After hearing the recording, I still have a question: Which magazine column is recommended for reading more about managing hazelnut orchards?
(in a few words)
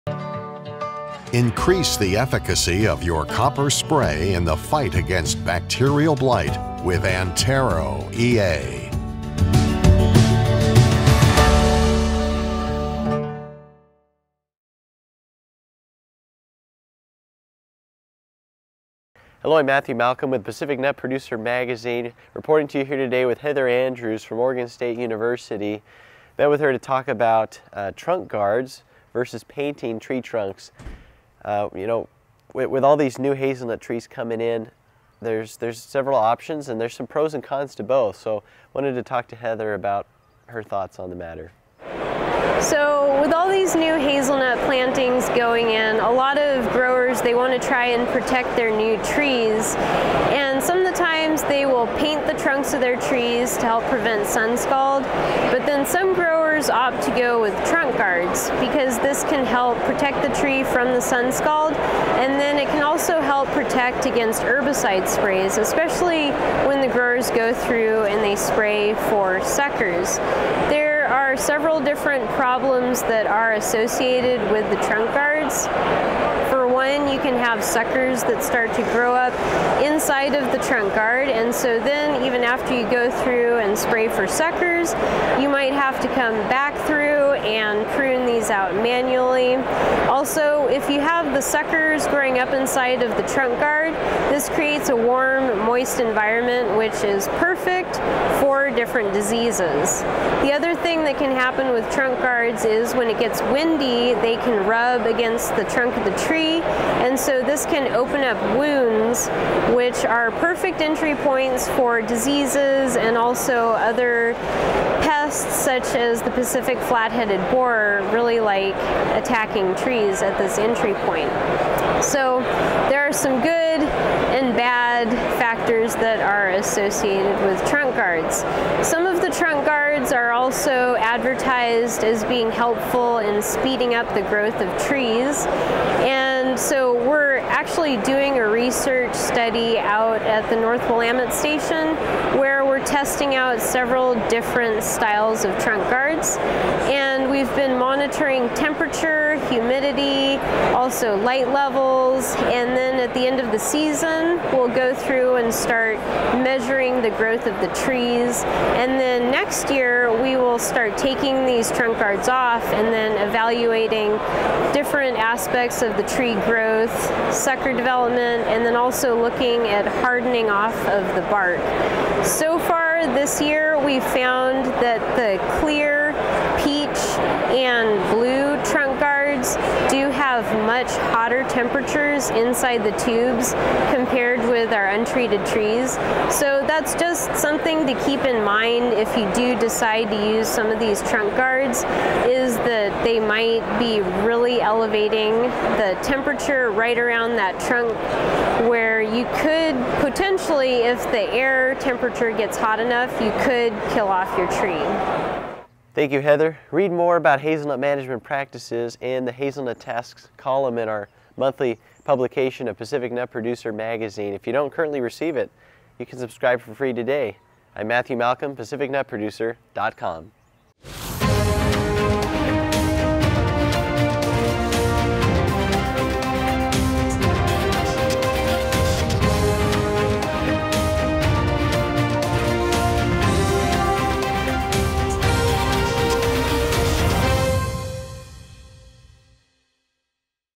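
Hazelnut Tasks.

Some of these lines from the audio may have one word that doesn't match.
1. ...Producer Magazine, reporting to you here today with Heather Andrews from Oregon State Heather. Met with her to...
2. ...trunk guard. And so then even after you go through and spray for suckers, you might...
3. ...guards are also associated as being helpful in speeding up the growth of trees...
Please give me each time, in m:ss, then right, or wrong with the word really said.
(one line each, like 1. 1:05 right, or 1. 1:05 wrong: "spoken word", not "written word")
1. 0:20 wrong: "University", not "Heather"
2. 1:20 right
3. 2:09 wrong: "advertised", not "associated".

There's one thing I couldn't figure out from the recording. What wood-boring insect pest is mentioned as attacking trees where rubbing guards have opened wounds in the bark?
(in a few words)
Pacific flat-headed borer.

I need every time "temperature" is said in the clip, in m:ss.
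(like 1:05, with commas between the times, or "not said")
2:28, 3:01, 3:16, 3:21.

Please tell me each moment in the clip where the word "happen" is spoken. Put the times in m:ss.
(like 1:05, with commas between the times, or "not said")
1:41.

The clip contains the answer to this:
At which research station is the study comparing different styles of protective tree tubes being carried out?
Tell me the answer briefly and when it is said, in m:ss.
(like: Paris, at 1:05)
North Willamette Station, at 2:20.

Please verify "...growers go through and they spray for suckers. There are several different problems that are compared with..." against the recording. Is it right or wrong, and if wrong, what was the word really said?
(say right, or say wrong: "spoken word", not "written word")
wrong: "associated", not "compared".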